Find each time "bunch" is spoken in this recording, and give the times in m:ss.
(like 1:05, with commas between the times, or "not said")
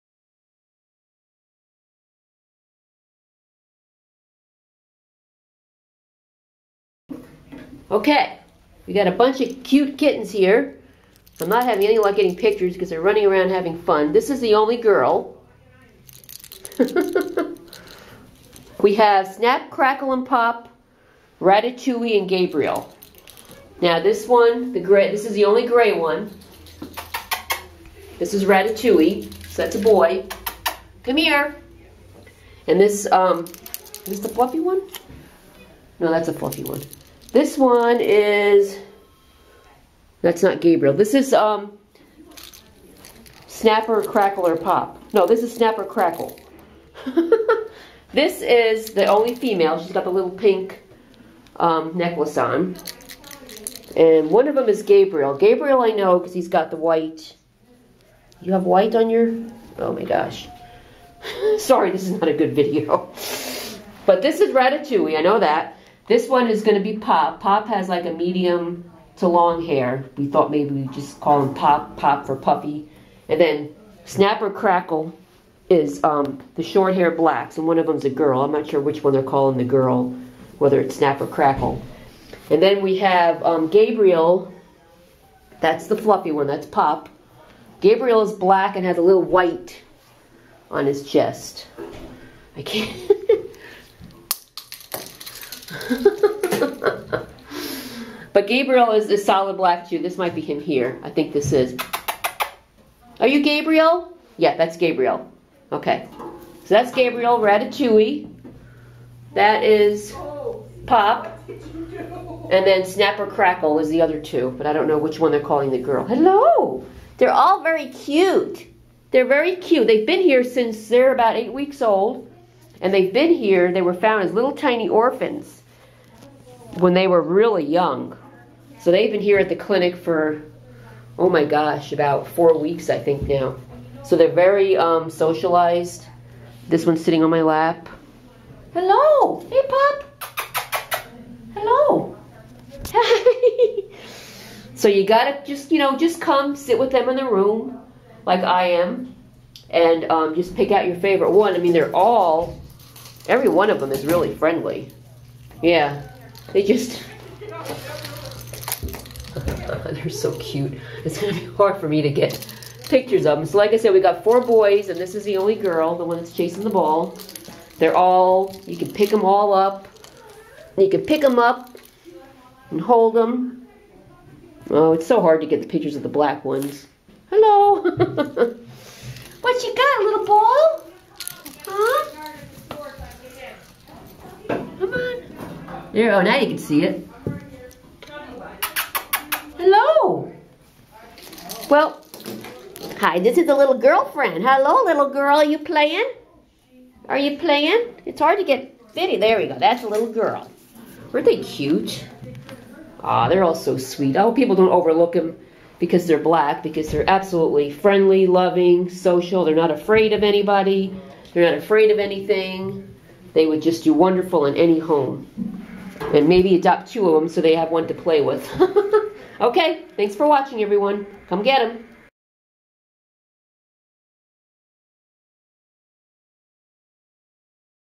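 0:09.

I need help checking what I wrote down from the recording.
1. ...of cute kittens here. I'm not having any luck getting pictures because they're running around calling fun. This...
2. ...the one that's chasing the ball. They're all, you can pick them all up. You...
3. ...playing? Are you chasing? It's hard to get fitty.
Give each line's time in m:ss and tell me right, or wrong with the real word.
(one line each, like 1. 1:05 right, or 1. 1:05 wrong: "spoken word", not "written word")
1. 0:09 wrong: "having", not "calling"
2. 2:45 right
3. 3:15 wrong: "playing", not "chasing".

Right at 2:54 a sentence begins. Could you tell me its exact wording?
Oh, it's so hard to get the pictures of the black ones.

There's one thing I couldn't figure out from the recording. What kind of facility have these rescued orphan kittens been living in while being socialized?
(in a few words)
clinic.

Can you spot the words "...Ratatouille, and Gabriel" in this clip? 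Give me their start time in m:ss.
0:21.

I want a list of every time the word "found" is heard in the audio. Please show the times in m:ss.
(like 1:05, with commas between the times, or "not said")
2:03.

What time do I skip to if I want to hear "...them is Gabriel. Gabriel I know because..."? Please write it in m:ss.
0:54.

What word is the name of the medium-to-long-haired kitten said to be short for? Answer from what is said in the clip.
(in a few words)
Puffy.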